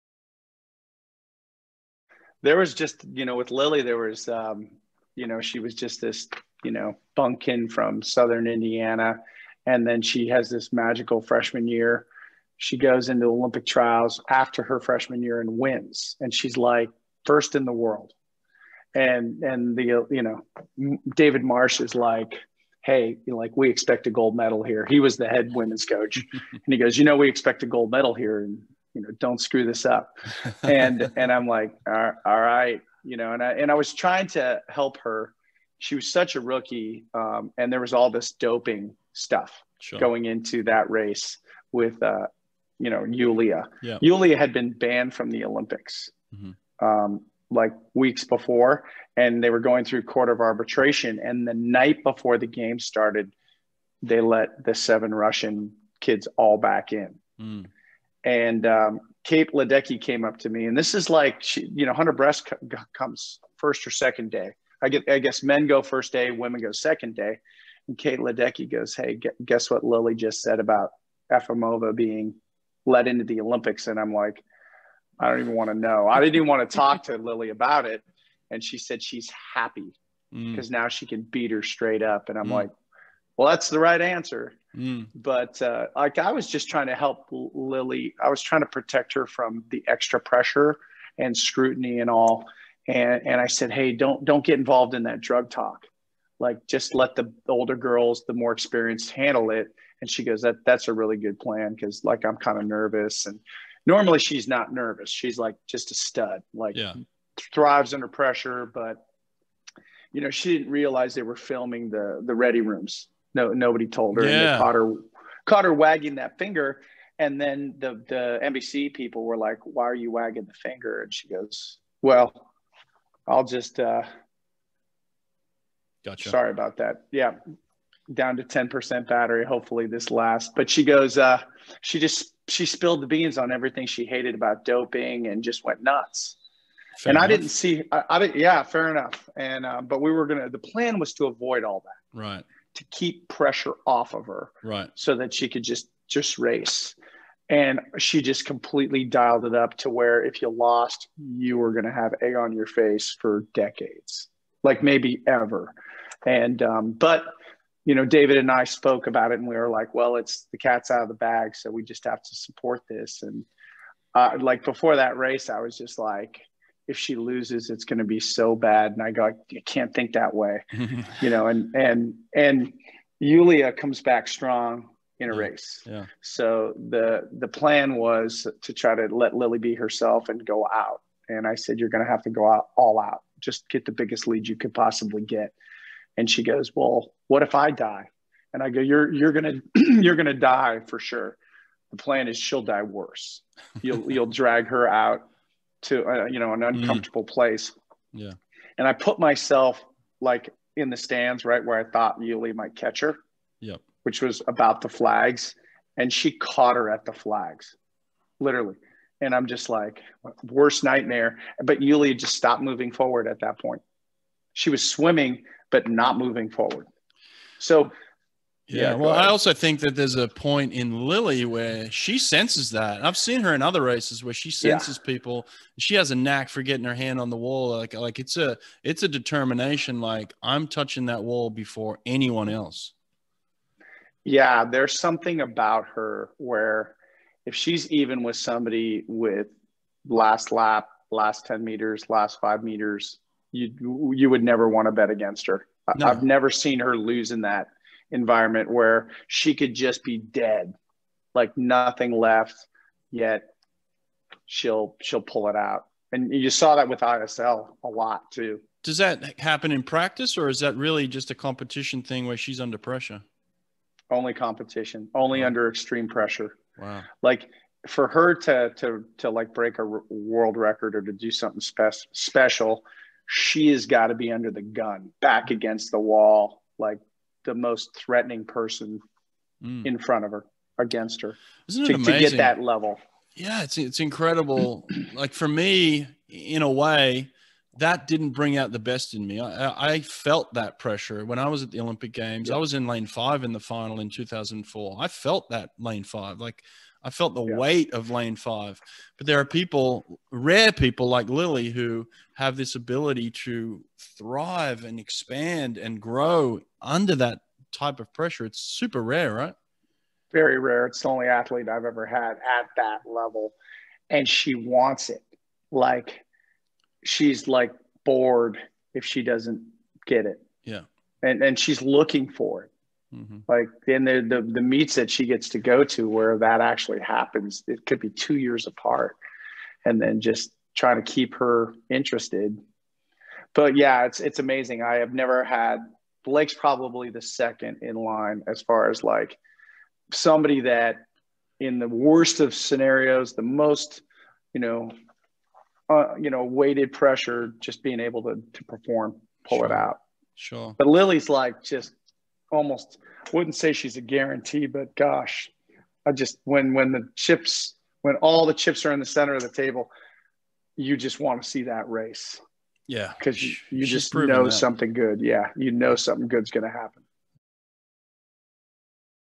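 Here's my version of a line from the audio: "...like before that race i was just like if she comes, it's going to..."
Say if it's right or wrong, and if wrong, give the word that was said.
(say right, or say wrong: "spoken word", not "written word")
wrong: "loses", not "comes".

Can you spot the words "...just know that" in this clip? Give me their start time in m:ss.
6:03.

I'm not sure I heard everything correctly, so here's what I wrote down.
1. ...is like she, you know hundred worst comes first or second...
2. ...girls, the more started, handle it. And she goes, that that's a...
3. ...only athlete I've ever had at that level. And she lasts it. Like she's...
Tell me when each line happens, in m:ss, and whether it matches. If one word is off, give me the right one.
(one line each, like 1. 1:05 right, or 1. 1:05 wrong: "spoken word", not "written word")
1. 1:00 wrong: "breast", not "worst"
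2. 1:37 wrong: "experienced", not "started"
3. 5:11 wrong: "wants", not "lasts".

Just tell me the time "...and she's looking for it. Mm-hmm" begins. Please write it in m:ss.
5:21.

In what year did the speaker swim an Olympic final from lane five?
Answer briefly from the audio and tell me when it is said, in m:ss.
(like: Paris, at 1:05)
2004, at 4:54.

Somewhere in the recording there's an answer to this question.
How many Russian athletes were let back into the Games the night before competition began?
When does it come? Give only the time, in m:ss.
0:54.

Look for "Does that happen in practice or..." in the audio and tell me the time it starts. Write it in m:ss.
4:18.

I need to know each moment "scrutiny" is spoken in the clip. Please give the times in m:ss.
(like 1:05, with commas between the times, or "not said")
1:31.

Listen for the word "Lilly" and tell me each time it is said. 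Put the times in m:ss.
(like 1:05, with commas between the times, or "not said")
0:03, 1:09, 1:17, 1:27, 3:41, 5:01, 5:50.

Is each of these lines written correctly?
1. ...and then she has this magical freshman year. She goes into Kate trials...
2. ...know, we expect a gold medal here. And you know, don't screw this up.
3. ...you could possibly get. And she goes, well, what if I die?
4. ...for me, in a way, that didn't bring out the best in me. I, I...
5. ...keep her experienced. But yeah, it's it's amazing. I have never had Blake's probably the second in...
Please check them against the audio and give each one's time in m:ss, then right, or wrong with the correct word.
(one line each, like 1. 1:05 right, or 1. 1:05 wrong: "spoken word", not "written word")
1. 0:09 wrong: "Olympic", not "Kate"
2. 0:27 right
3. 3:04 right
4. 4:45 right
5. 5:31 wrong: "interested", not "experienced".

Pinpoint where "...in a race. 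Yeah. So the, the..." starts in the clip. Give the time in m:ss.
2:55.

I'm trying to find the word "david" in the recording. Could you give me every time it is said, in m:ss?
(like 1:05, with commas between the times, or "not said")
0:21, 2:38.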